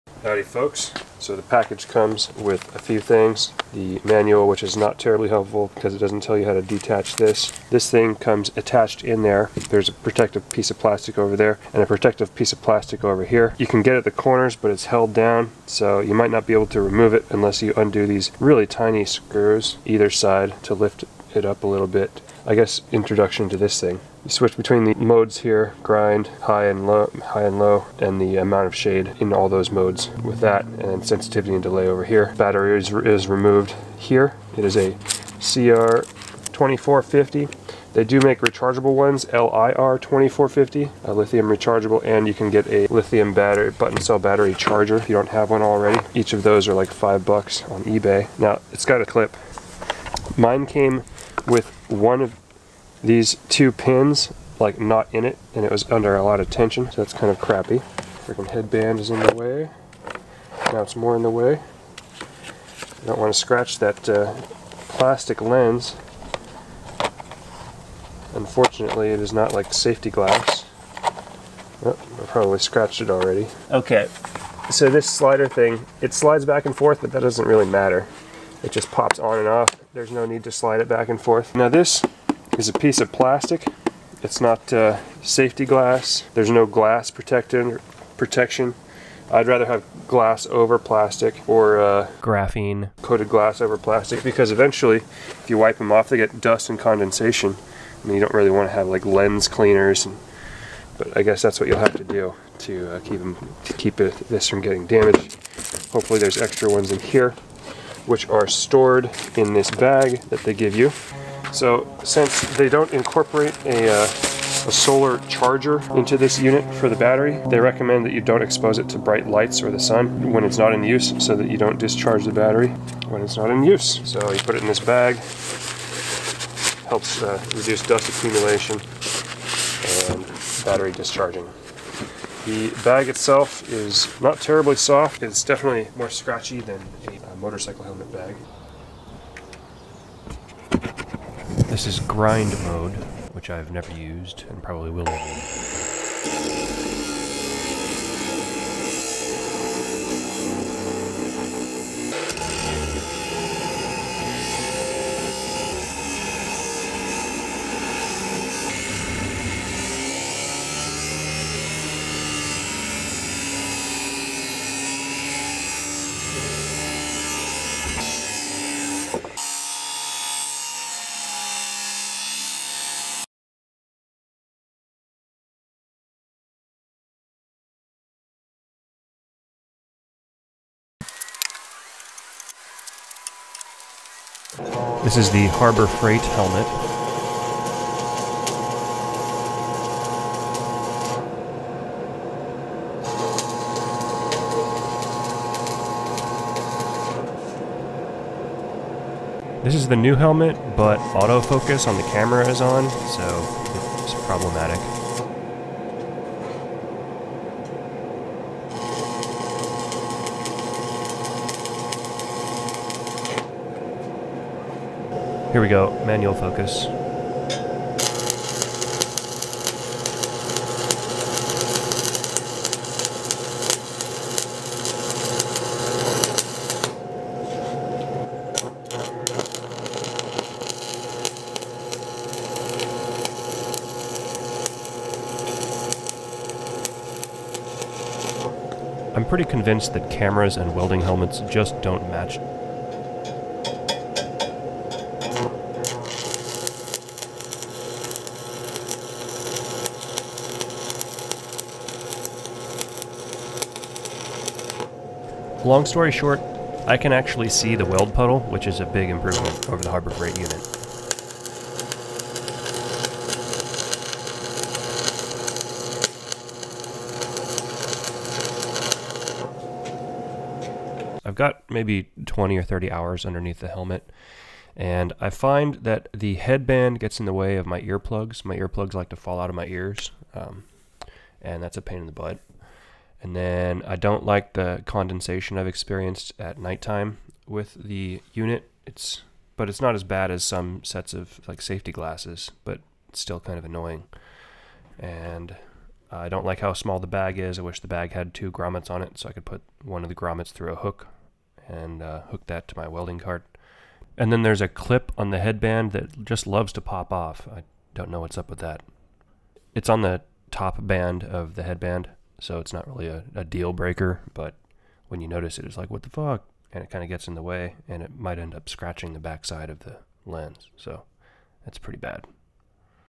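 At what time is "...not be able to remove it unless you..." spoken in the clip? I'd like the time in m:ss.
0:16.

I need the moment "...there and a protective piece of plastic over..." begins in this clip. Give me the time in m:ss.
0:11.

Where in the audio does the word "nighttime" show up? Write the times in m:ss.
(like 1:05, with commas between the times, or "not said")
4:46.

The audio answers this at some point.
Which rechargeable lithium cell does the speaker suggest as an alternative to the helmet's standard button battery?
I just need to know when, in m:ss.
0:39.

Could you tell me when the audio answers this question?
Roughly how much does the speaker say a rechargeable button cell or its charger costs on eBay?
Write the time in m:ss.
0:46.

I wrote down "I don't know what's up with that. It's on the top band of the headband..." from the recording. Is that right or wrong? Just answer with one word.
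right.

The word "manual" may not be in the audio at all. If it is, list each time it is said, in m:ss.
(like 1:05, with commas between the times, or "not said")
0:04, 3:36.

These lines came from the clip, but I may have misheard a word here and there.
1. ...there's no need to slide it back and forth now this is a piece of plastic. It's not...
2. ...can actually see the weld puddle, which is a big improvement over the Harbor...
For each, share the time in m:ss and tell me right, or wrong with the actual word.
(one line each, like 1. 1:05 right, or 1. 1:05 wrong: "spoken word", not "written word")
1. 1:19 right
2. 4:16 right.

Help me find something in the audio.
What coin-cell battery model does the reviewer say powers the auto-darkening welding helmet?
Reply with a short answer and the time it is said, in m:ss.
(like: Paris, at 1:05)
CR2450, at 0:35.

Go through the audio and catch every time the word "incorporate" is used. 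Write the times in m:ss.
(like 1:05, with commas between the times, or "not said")
1:52.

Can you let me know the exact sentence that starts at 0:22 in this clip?
I guess introduction to this thing.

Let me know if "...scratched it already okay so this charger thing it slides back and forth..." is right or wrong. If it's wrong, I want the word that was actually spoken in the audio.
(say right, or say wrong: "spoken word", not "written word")
wrong: "slider", not "charger".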